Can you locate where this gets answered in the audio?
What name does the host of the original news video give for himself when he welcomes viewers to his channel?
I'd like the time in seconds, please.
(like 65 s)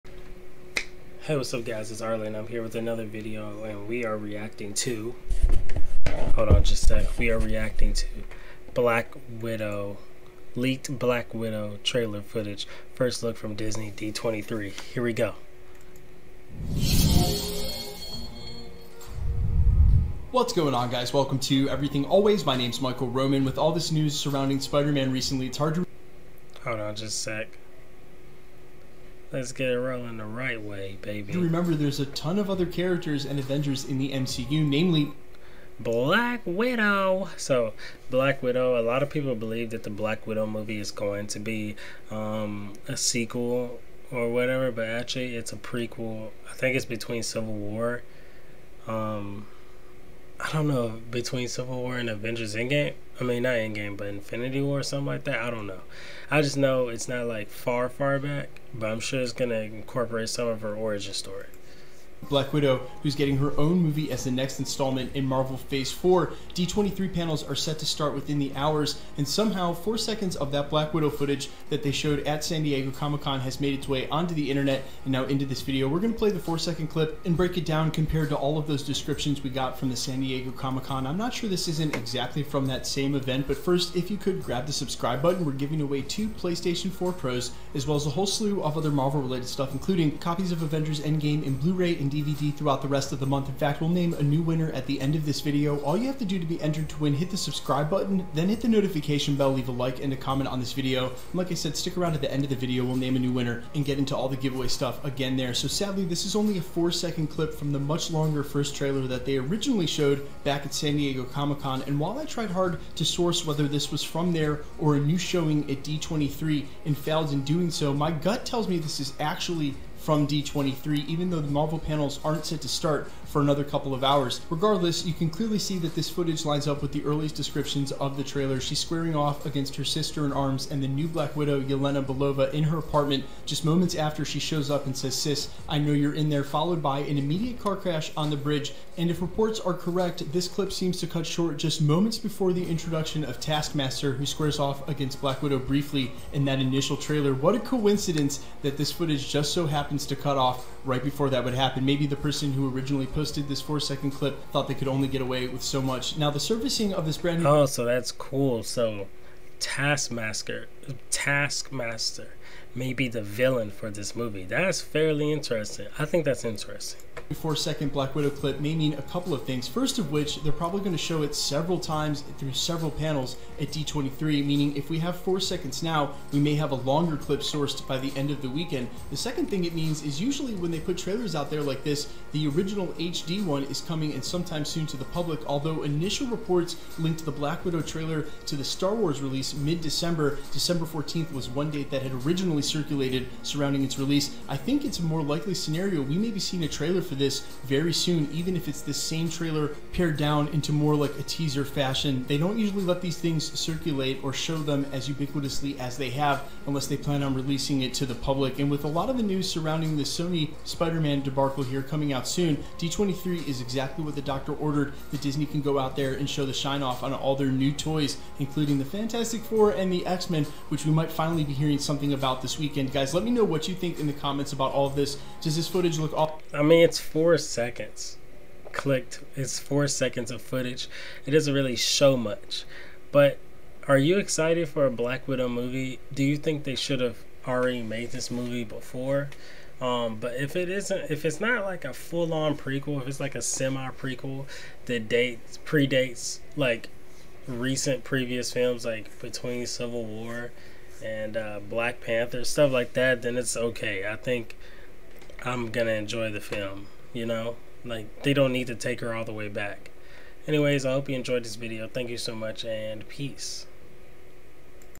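22 s.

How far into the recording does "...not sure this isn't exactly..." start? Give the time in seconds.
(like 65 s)
81 s.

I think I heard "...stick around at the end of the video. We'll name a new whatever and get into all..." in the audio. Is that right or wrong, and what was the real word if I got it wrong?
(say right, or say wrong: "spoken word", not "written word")
wrong: "winner", not "whatever".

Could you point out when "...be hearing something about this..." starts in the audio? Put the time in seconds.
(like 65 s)
221 s.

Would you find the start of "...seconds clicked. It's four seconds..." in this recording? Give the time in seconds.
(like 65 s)
227 s.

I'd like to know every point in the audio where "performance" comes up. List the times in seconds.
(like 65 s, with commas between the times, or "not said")
not said.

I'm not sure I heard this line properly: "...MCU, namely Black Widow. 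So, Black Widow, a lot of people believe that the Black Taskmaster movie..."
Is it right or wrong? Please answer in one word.
wrong.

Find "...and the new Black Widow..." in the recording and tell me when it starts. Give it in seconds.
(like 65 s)
130 s.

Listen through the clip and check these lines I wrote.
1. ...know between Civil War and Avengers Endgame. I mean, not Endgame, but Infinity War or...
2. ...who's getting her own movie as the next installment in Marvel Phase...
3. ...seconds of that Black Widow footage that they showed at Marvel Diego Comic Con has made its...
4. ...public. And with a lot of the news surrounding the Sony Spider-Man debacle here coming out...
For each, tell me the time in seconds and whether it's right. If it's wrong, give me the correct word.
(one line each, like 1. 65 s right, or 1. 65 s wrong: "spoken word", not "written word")
1. 50 s right
2. 63 s right
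3. 69 s wrong: "San", not "Marvel"
4. 208 s right.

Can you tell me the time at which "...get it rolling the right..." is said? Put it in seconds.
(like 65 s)
29 s.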